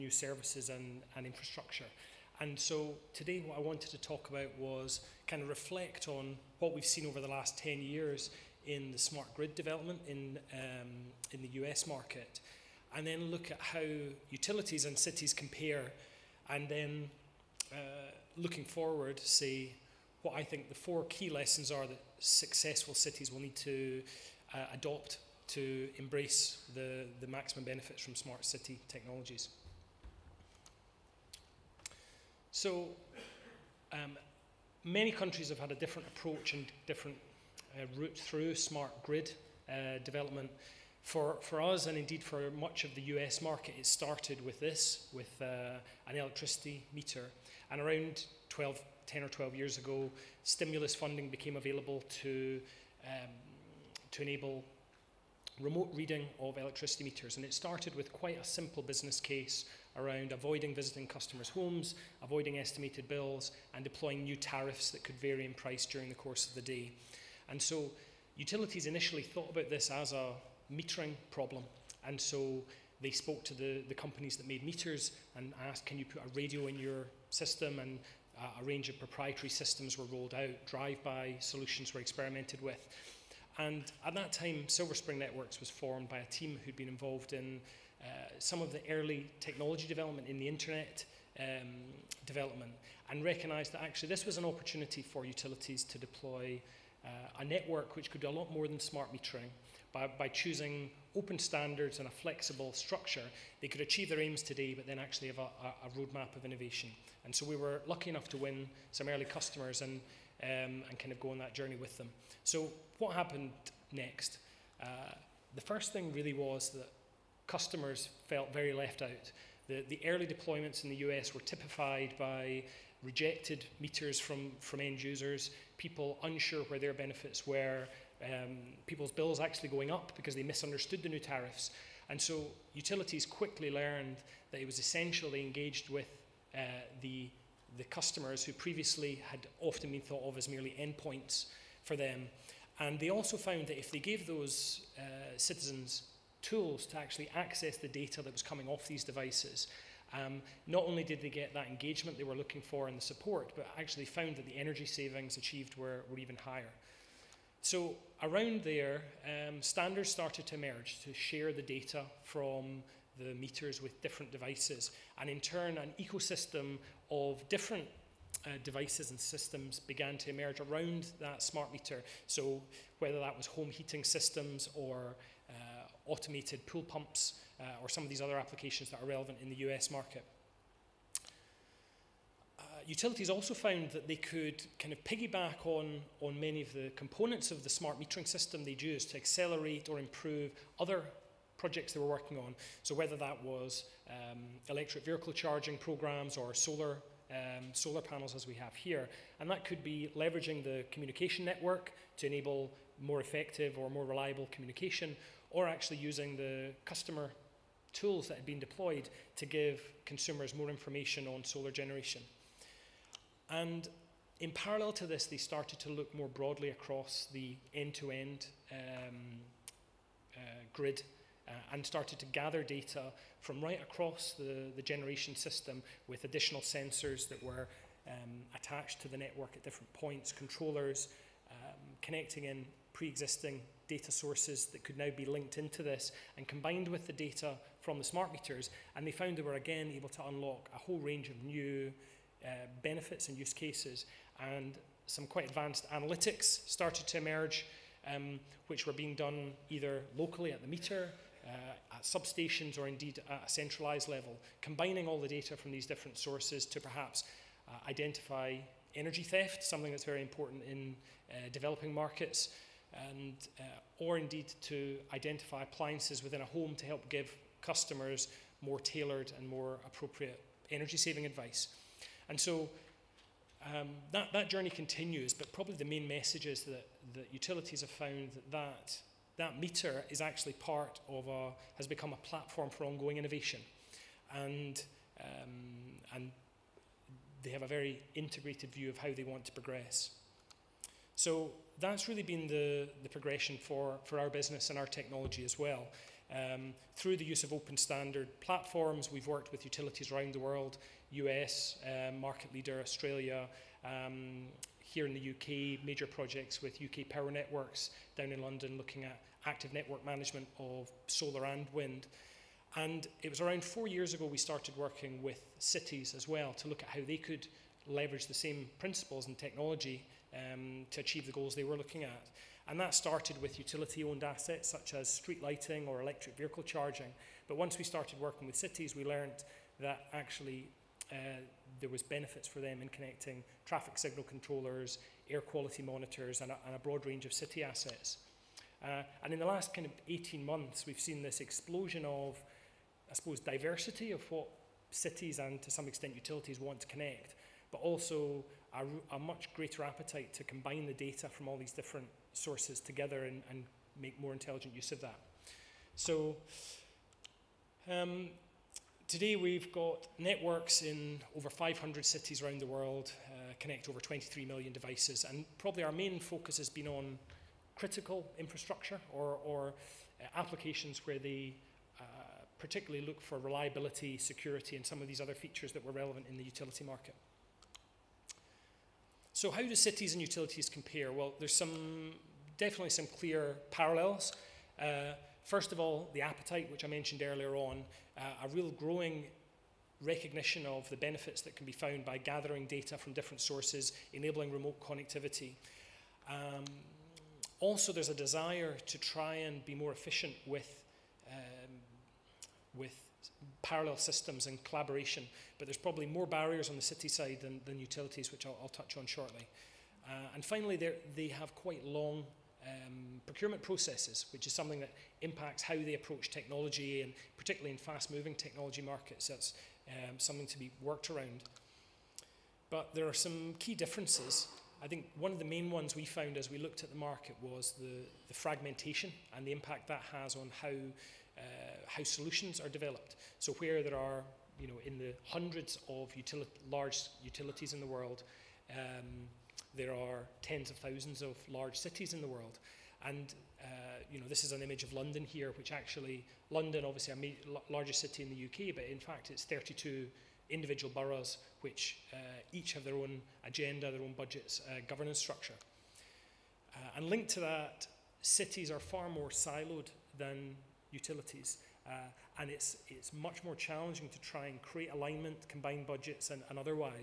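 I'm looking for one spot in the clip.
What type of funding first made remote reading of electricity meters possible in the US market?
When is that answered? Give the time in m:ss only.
0:50.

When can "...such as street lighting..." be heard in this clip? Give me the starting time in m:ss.
5:24.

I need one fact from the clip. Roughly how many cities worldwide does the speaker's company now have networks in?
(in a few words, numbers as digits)
over 500.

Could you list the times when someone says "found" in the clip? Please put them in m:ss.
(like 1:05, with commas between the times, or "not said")
2:23, 2:34, 3:03, 3:59, 4:37, 6:31, 7:06.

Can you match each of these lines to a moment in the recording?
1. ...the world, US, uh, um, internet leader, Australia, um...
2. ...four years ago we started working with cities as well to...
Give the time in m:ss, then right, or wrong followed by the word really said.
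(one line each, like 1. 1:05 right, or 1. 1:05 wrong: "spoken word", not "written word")
1. 5:00 wrong: "market", not "internet"
2. 5:13 right.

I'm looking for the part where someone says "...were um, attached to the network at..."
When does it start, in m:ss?
3:47.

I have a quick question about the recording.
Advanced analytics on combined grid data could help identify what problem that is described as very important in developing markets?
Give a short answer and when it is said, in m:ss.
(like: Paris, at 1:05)
Energy theft, at 4:18.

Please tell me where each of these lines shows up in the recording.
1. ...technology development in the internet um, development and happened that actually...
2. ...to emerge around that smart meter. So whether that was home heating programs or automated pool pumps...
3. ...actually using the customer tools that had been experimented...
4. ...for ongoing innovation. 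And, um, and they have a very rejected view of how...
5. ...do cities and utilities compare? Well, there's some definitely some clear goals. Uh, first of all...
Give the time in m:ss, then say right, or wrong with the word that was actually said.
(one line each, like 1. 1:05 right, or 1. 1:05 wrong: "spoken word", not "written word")
1. 1:29 wrong: "recognized", not "happened"
2. 2:50 wrong: "systems", not "programs"
3. 3:25 wrong: "deployed", not "experimented"
4. 4:42 wrong: "integrated", not "rejected"
5. 6:19 wrong: "parallels", not "goals".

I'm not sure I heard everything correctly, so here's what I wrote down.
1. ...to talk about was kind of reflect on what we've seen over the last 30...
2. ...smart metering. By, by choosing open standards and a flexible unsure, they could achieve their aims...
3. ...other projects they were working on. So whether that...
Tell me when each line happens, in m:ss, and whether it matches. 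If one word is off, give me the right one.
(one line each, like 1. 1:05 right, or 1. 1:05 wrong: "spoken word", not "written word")
1. 0:03 wrong: "10", not "30"
2. 1:38 wrong: "structure", not "unsure"
3. 3:10 right.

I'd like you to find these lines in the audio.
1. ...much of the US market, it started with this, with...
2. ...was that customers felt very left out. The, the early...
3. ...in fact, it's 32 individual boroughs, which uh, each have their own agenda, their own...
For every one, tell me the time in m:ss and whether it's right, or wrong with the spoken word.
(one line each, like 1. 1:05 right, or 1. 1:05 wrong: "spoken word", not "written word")
1. 0:42 right
2. 1:56 right
3. 7:28 right.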